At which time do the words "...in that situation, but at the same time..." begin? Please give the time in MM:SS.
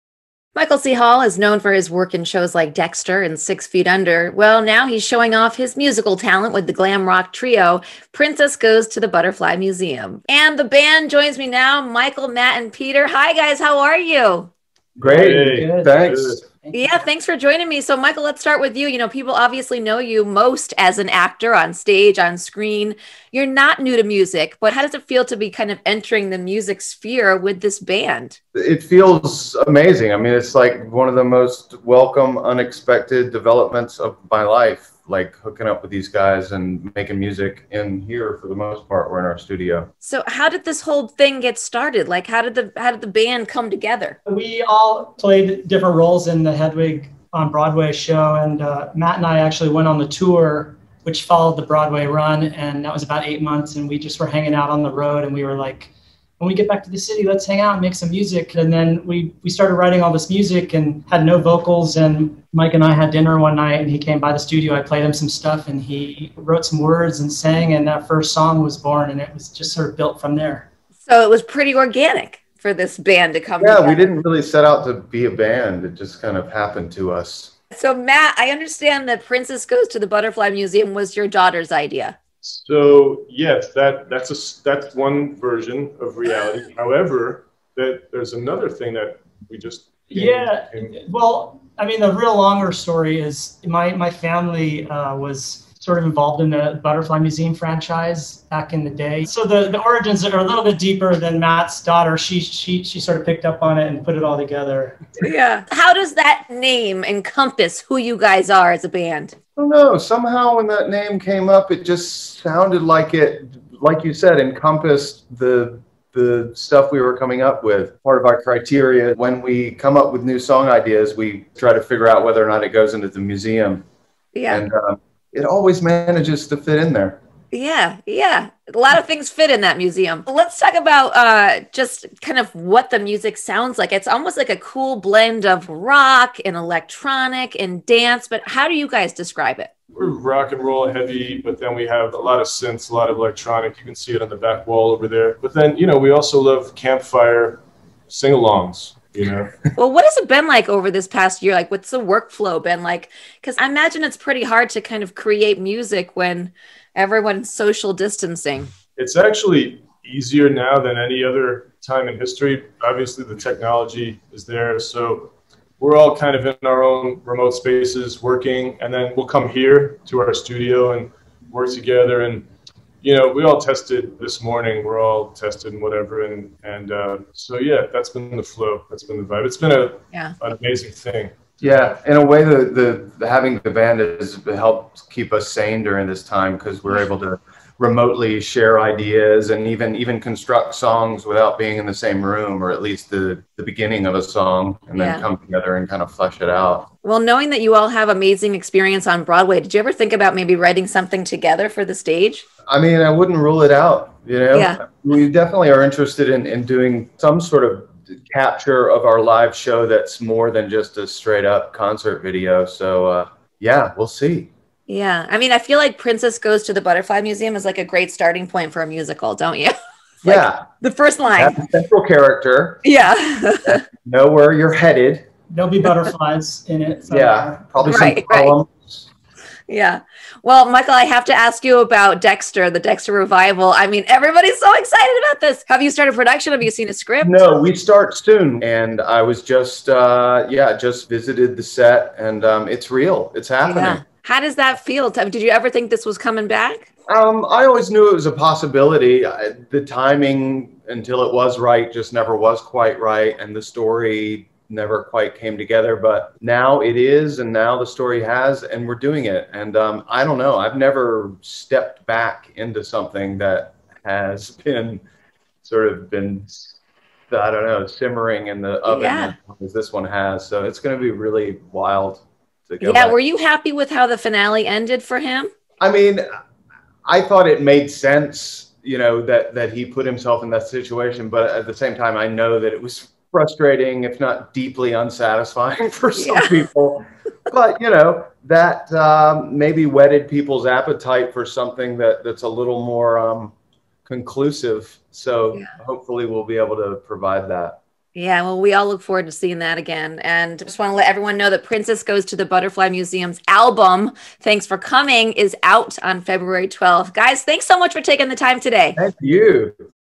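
04:40.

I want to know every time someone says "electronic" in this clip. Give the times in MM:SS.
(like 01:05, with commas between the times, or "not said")
02:16, 02:23.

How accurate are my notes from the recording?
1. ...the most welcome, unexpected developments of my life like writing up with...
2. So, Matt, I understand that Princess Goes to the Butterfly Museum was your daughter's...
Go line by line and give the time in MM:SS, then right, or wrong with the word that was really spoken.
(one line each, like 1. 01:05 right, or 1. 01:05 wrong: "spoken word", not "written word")
1. 00:31 wrong: "hooking", not "writing"
2. 01:17 right.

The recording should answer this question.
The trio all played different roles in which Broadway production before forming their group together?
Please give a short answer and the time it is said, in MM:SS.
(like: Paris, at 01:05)
Hedwig, at 00:46.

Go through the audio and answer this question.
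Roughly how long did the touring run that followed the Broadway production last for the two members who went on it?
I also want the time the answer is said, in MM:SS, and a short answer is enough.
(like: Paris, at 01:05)
8 months, at 00:53.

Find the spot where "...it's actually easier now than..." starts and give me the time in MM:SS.
02:38.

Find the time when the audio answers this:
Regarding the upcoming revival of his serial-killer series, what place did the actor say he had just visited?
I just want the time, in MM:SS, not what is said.
04:01.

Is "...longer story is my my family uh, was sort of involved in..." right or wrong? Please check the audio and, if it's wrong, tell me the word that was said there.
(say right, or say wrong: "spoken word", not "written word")
right.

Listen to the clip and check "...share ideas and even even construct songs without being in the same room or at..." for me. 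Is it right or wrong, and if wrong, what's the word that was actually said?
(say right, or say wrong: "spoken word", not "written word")
right.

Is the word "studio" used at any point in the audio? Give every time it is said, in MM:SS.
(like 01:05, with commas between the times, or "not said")
00:39, 01:04, 02:50.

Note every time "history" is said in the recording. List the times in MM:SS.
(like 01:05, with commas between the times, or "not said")
02:42.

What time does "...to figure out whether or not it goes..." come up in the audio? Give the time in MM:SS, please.
02:01.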